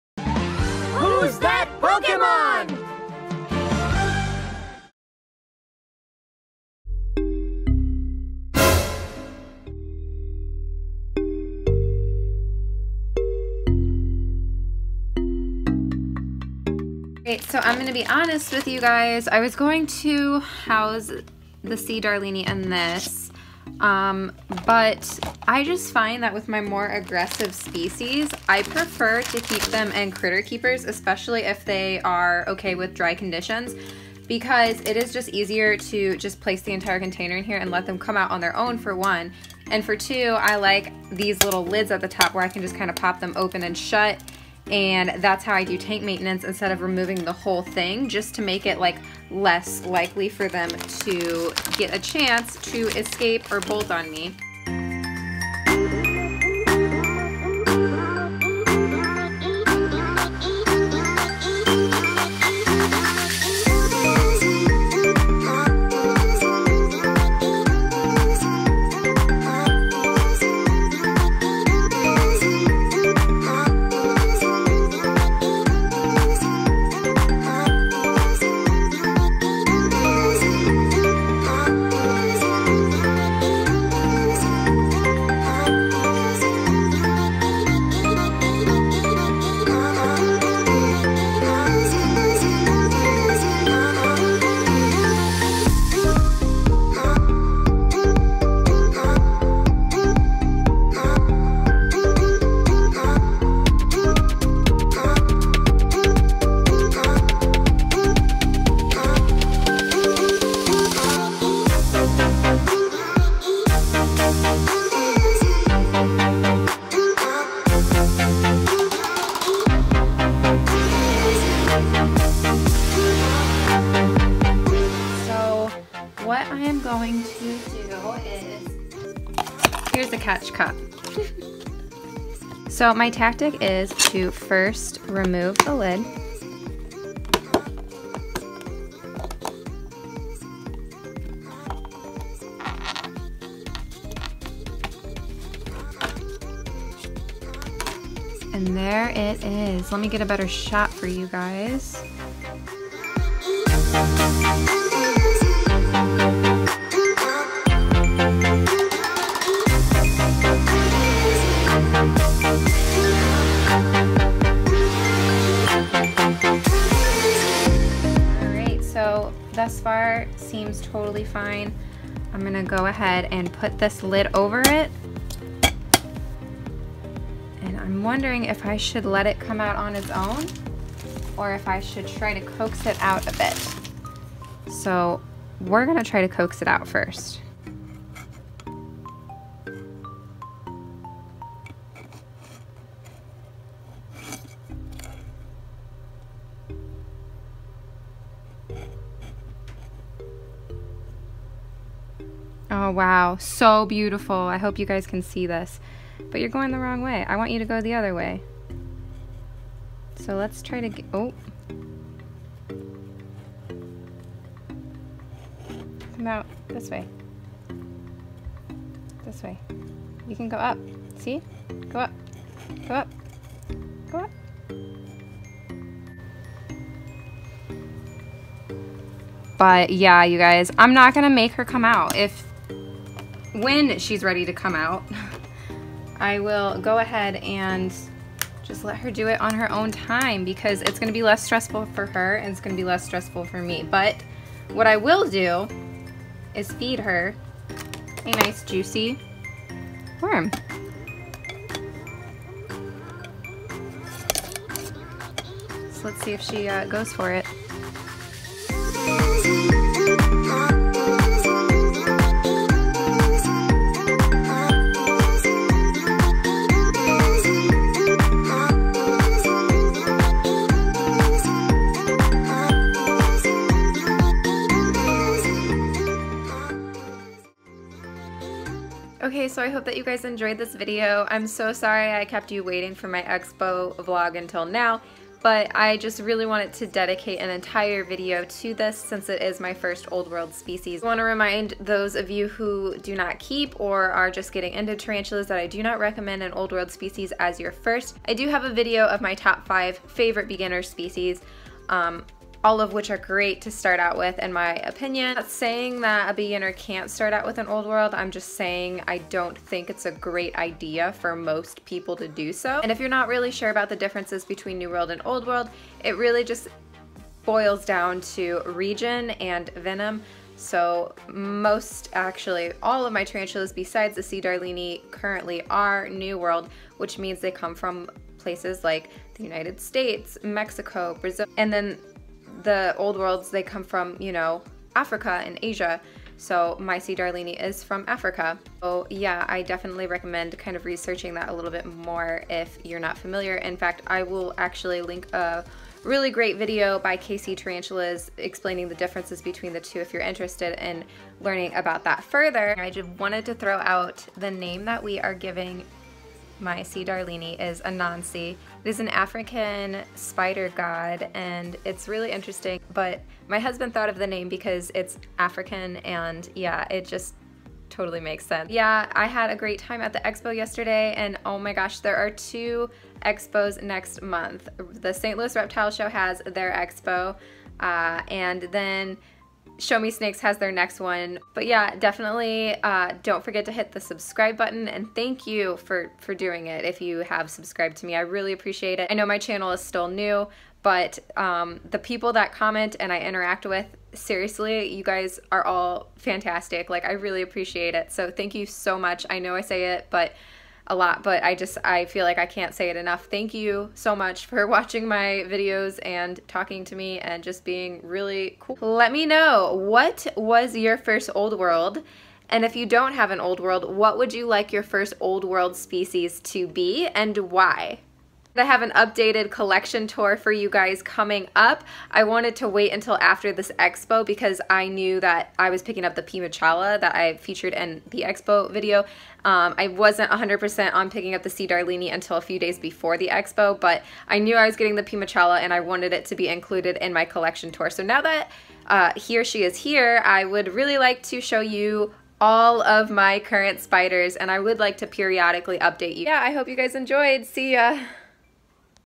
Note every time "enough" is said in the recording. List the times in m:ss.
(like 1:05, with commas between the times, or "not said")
6:42.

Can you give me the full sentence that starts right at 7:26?
Yeah, I hope you guys enjoyed.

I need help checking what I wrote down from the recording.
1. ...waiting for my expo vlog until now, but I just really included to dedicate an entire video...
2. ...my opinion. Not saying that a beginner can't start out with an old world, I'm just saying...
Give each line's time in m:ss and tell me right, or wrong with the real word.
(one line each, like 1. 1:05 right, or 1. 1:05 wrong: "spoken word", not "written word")
1. 4:42 wrong: "wanted", not "included"
2. 5:04 right.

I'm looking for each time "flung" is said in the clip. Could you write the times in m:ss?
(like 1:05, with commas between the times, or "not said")
not said.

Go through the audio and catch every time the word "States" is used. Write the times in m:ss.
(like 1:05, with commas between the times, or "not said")
5:29.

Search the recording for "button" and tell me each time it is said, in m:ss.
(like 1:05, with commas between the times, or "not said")
6:24.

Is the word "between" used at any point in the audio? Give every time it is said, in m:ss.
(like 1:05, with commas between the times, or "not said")
5:14, 5:49.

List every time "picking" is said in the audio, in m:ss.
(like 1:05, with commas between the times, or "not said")
7:05, 7:11.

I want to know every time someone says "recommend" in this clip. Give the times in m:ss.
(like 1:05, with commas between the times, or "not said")
4:55, 5:40.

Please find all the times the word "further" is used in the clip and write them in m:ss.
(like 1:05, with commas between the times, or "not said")
5:52.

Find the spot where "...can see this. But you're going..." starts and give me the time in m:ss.
3:25.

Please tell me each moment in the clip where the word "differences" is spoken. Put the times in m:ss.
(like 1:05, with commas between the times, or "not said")
5:13, 5:48.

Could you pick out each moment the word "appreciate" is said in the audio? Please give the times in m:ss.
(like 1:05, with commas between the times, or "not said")
6:28, 6:37.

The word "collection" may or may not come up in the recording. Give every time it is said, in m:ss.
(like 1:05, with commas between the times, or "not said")
6:59, 7:17.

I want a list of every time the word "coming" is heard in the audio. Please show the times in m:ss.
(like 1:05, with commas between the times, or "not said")
7:01.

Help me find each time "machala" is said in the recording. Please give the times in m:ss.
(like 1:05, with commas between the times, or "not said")
7:06, 7:15.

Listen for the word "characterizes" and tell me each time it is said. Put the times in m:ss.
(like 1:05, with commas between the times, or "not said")
not said.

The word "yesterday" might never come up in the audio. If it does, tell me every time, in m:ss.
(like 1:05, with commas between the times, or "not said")
6:10.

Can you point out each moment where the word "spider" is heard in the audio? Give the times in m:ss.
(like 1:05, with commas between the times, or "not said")
6:00, 7:23.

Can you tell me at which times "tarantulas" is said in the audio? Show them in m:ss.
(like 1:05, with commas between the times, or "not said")
4:54, 5:23, 5:47.